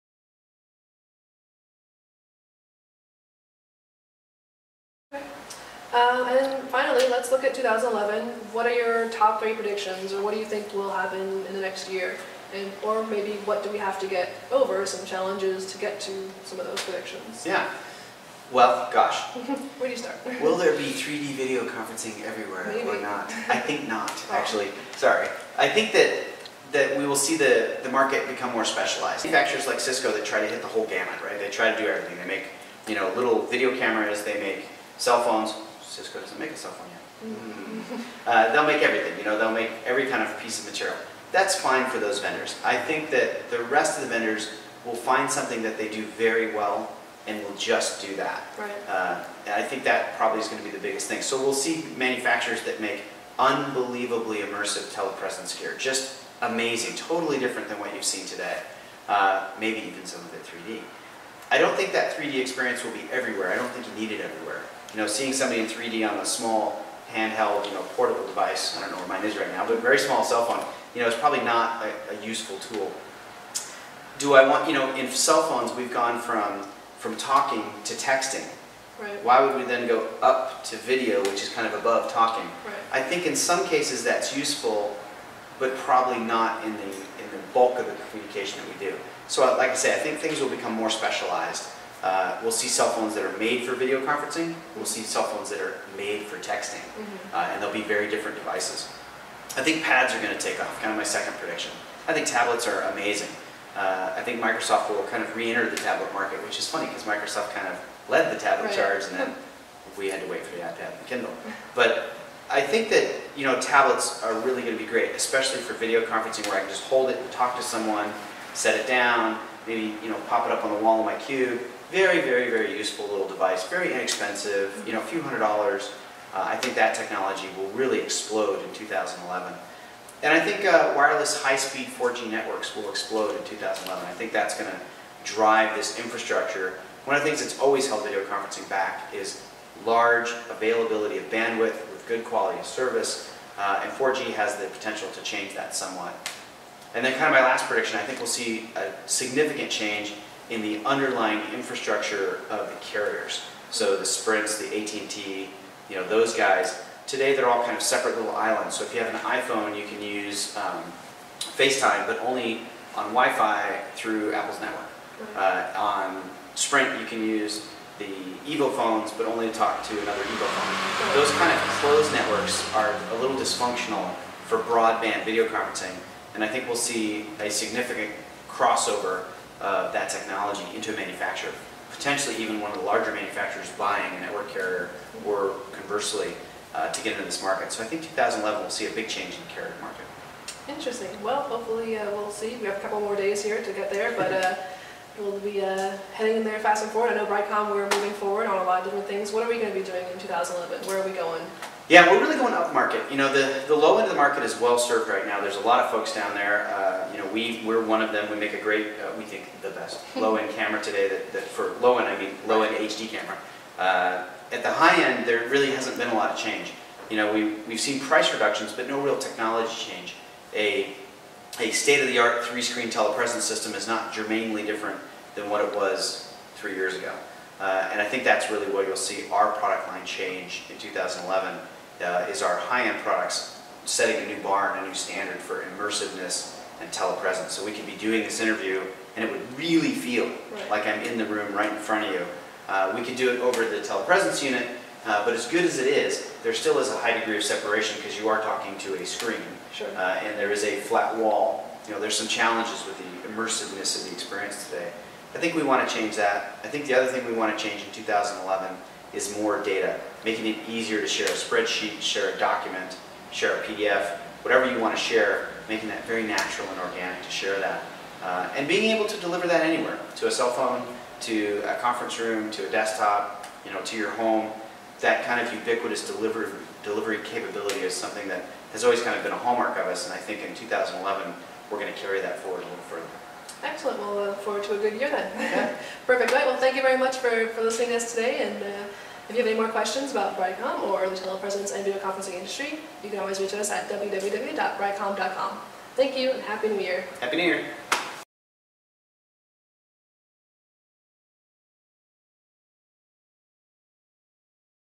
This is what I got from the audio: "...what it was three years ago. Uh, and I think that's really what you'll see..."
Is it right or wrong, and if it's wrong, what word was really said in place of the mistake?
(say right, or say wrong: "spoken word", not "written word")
right.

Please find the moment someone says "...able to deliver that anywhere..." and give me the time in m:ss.
4:28.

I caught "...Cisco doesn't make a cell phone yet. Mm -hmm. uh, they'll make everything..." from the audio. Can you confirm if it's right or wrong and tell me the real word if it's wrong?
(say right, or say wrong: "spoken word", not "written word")
right.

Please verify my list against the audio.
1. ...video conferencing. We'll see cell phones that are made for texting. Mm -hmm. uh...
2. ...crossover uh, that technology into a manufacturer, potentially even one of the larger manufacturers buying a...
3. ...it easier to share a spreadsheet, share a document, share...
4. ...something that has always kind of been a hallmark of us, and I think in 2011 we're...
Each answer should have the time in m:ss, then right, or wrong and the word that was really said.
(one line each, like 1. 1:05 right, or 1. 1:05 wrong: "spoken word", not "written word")
1. 1:33 right
2. 2:58 right
3. 4:20 right
4. 4:37 right.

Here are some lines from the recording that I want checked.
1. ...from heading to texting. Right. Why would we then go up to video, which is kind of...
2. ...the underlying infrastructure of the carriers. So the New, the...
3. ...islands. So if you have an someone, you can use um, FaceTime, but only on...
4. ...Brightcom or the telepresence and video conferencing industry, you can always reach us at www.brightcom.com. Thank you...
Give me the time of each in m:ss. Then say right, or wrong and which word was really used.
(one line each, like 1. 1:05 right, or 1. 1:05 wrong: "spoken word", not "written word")
1. 1:16 wrong: "talking", not "heading"
2. 2:30 wrong: "Sprints", not "New"
3. 2:38 wrong: "iPhone", not "someone"
4. 4:50 right.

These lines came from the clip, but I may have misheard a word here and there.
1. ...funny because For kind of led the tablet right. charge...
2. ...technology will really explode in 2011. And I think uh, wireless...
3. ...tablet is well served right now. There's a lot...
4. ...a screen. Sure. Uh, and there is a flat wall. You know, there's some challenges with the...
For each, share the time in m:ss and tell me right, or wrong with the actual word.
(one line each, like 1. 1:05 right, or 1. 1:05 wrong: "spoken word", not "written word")
1. 1:46 wrong: "Microsoft", not "For"
2. 2:06 right
3. 3:24 wrong: "market", not "tablet"
4. 4:09 right.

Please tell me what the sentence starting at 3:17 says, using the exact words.
I know Brightcom, we're moving forward on a lot of different things.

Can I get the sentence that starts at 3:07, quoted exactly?
So I think 2011 will see a big change in the carrier market.